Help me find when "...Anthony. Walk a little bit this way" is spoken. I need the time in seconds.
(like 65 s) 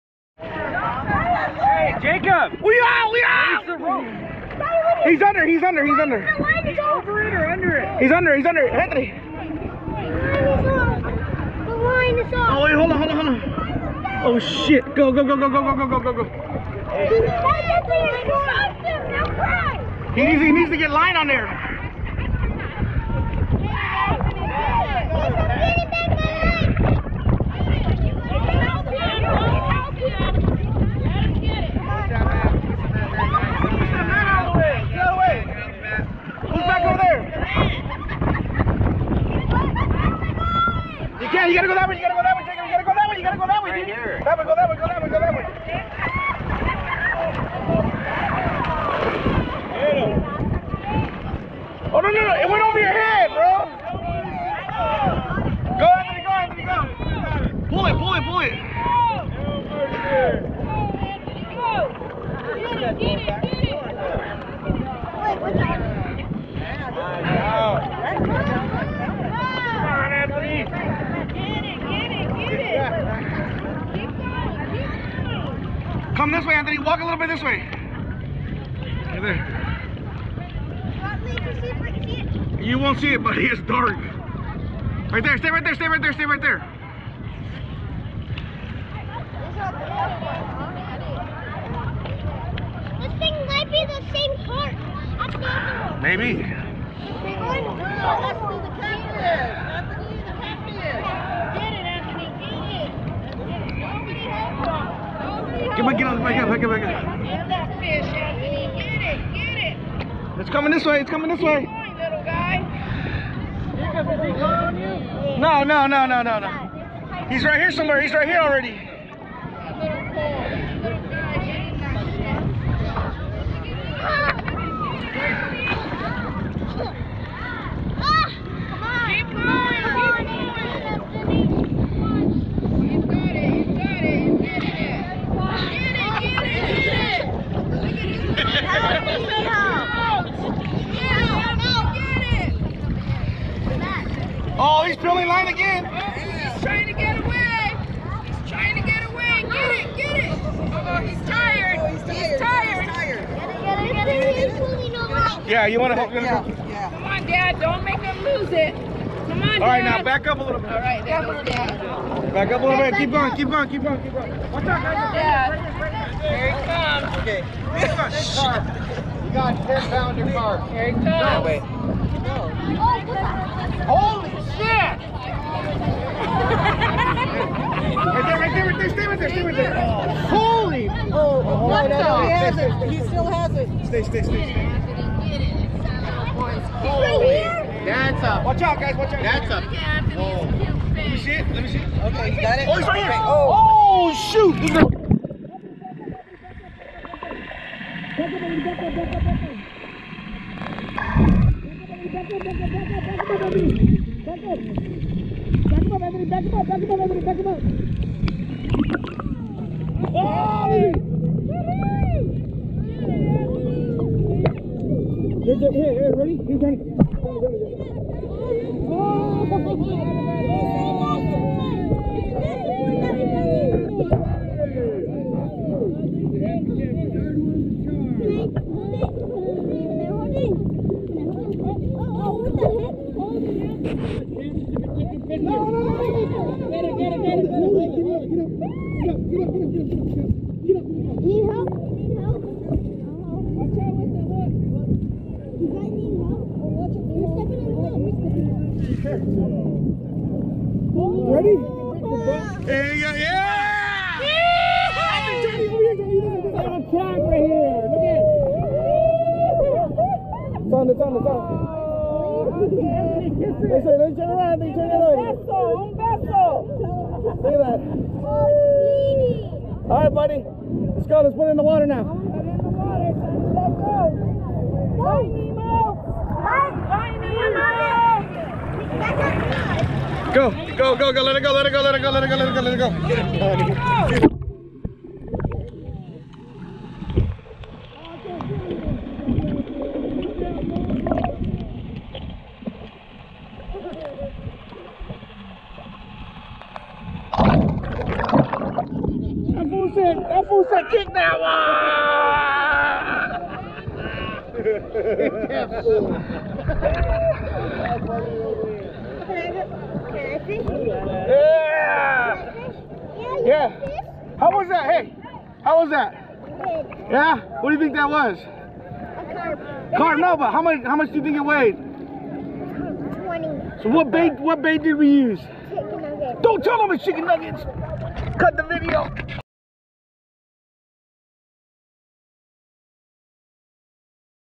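76 s.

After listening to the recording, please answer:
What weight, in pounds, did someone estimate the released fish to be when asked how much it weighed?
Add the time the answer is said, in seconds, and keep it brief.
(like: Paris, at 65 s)
20, at 321 s.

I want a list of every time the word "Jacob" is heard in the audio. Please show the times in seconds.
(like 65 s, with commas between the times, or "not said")
2 s, 42 s.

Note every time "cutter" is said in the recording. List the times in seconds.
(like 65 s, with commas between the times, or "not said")
not said.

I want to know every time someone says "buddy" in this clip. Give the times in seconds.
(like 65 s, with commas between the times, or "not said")
83 s, 270 s.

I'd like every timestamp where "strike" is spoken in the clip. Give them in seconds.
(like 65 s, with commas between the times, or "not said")
not said.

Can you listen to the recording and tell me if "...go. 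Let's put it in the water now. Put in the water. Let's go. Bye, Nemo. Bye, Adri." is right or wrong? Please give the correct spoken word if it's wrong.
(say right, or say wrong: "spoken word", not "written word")
wrong: "Nemo", not "Adri".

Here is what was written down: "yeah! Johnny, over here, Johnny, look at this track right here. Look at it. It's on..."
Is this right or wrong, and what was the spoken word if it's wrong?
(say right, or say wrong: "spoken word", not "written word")
right.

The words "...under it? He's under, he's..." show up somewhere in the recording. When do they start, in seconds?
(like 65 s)
7 s.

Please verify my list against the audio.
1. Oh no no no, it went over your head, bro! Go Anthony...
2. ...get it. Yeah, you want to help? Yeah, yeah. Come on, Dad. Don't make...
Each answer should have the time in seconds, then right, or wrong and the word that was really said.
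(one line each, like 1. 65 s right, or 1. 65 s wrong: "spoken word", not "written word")
1. 51 s right
2. 154 s right.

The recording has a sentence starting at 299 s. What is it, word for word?
said, that fool said, kick that one!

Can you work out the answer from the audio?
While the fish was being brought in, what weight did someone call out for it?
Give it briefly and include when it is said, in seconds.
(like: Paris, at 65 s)
10 pounds, at 169 s.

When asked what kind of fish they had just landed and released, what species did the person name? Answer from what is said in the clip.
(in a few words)
Carp.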